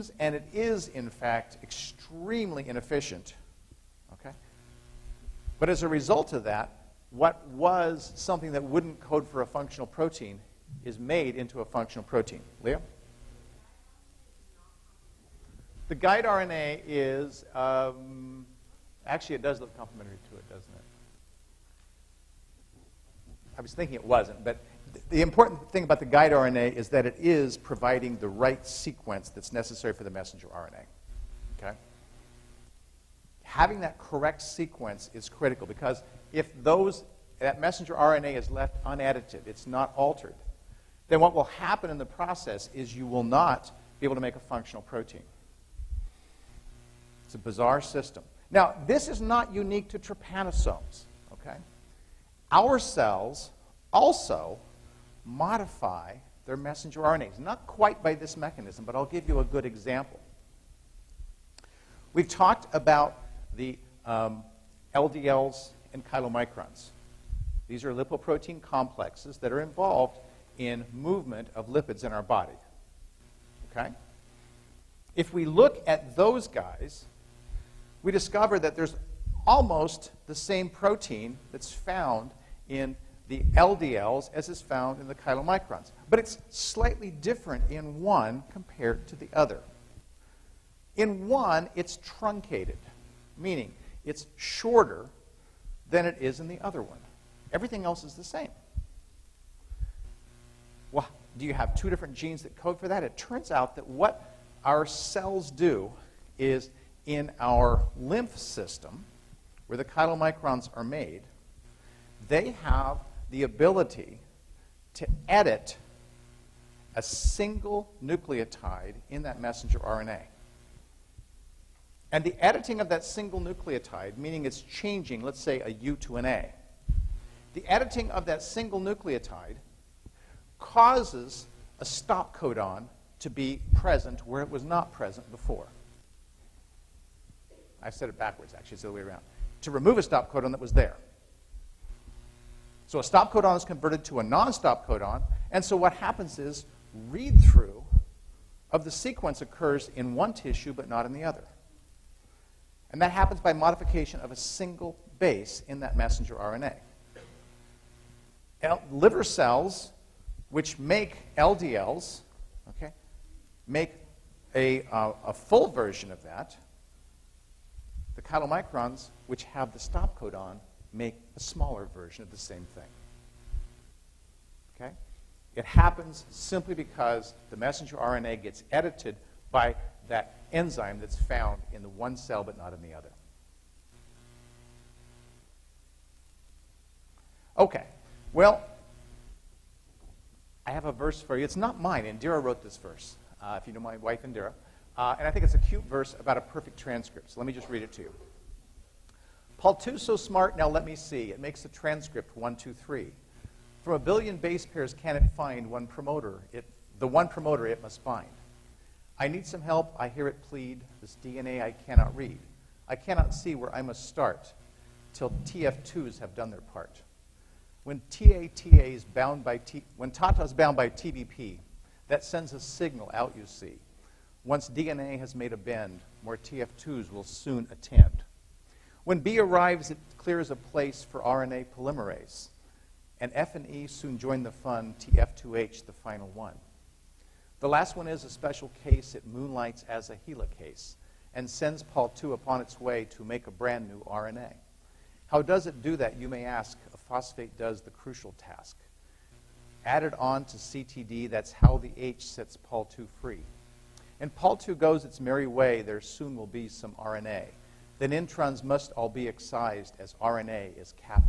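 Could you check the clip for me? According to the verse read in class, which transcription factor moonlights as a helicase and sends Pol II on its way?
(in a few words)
TF2H.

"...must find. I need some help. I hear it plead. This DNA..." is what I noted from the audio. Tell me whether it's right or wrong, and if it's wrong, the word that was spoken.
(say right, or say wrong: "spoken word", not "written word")
right.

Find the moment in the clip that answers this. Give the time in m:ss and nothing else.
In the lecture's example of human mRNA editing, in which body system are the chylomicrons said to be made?
1:47.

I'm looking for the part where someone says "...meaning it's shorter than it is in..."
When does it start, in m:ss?
1:33.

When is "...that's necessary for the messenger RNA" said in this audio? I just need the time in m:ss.
0:29.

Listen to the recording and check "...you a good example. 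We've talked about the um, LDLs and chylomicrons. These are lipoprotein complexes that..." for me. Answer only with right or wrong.
right.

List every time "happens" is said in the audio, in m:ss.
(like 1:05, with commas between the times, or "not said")
0:41, 2:25, 2:33, 2:55.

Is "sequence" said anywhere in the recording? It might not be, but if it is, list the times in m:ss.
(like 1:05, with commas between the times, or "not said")
0:28, 0:34, 2:28.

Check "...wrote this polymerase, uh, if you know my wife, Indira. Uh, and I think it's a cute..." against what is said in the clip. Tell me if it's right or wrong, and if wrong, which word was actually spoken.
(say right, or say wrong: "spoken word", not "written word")
wrong: "verse", not "polymerase".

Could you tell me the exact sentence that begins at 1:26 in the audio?
But it's slightly different in one compared to the other.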